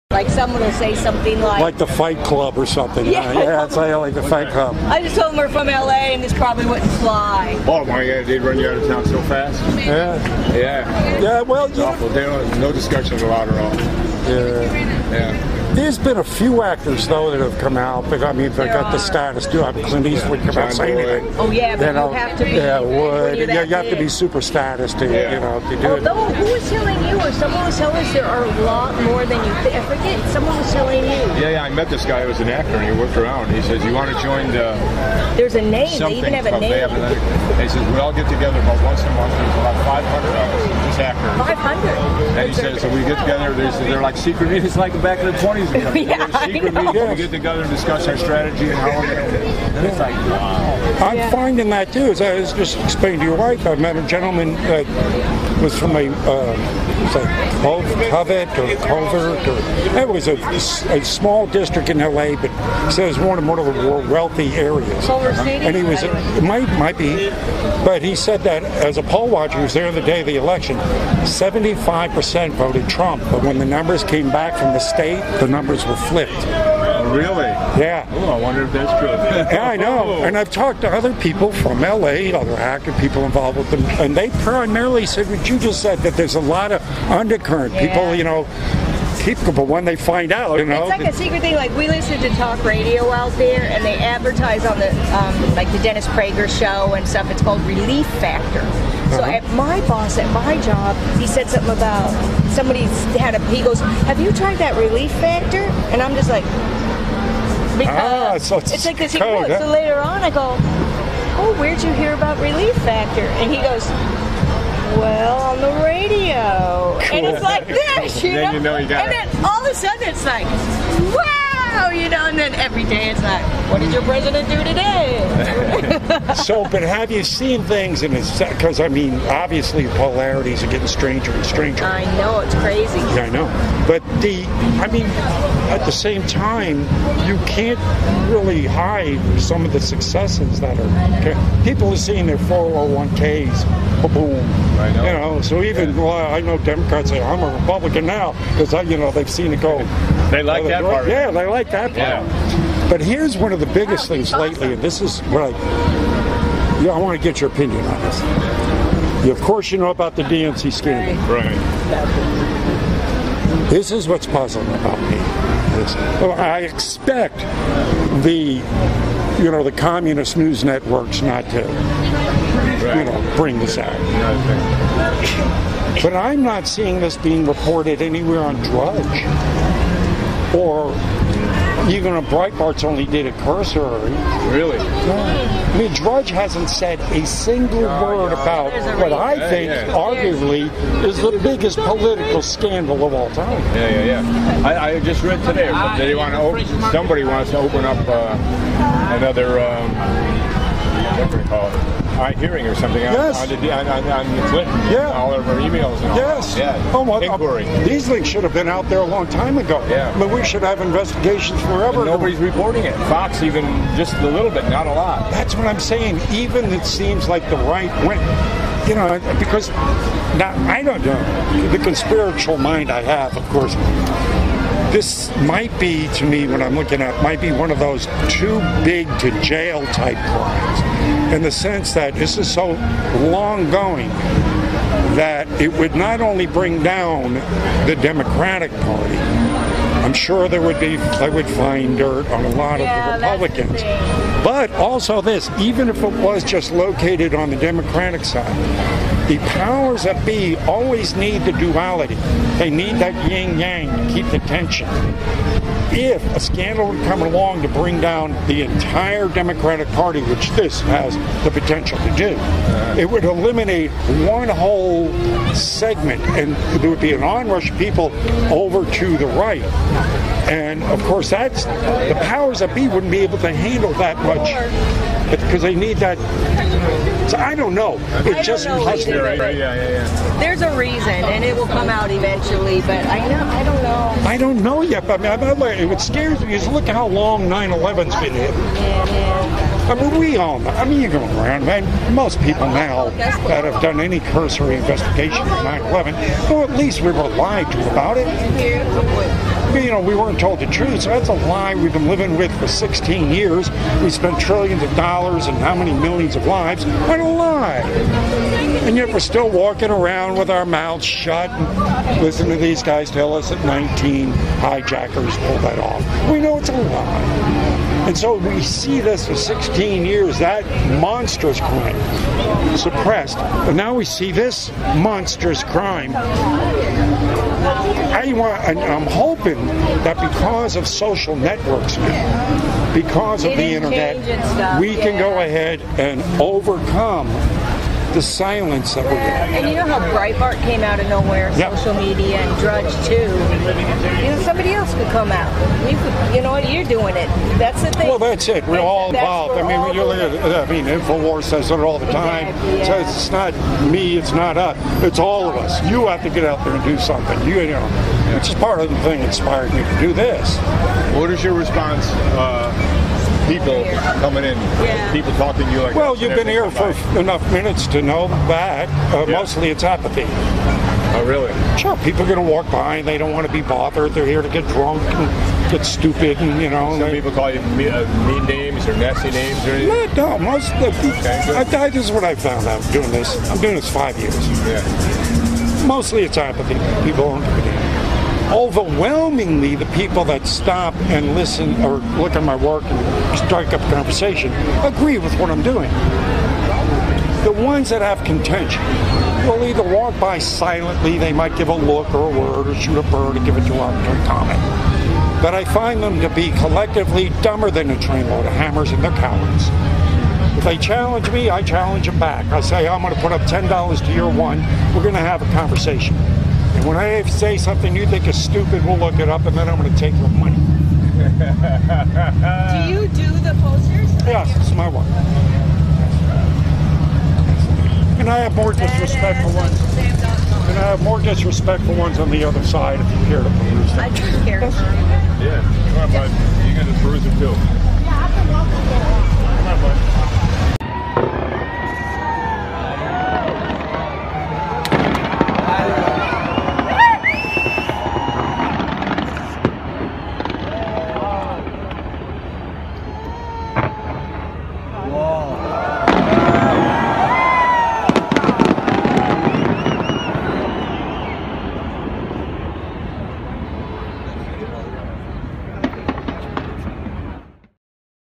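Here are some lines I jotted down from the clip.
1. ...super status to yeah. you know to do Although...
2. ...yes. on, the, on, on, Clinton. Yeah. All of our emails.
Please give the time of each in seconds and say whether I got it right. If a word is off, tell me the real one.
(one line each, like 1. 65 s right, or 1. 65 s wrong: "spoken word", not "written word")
1. 24 s right
2. 203 s right.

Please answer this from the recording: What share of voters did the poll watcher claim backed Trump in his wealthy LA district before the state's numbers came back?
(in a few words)
75%.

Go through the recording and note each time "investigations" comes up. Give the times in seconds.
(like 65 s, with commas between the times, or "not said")
210 s, 294 s.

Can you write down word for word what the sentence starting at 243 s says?
The but also this, even if it was just located on the Democratic side, the powers that be always need the duality.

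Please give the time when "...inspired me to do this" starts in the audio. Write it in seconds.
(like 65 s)
359 s.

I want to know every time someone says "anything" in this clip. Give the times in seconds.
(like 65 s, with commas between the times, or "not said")
20 s, 379 s.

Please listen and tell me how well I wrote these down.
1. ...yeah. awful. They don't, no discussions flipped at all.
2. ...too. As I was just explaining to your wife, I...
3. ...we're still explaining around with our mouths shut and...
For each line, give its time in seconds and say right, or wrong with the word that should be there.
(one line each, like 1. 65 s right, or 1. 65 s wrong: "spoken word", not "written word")
1. 11 s wrong: "allowed", not "flipped"
2. 51 s right
3. 309 s wrong: "walking", not "explaining".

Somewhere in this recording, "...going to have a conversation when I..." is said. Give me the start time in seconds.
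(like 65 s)
415 s.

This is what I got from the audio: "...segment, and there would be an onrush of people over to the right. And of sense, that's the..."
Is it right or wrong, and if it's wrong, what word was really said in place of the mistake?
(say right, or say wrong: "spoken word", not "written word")
wrong: "course", not "sense".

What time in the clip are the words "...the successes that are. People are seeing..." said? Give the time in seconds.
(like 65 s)
139 s.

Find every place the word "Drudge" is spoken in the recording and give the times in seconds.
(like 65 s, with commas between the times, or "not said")
178 s, 185 s, 342 s.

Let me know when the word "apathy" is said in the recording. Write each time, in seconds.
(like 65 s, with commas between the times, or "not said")
369 s, 386 s.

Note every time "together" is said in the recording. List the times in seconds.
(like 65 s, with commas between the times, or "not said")
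38 s, 43 s, 47 s.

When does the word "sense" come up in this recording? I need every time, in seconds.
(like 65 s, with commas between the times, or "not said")
231 s.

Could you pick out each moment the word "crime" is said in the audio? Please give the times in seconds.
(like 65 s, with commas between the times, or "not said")
230 s, 321 s, 325 s.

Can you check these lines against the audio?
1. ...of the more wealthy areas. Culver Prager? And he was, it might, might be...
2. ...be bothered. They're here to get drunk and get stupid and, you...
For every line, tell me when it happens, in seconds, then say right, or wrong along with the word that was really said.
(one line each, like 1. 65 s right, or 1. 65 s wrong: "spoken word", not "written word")
1. 63 s wrong: "City", not "Prager"
2. 373 s right.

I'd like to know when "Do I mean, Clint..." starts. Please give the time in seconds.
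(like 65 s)
19 s.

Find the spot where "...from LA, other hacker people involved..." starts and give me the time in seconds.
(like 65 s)
81 s.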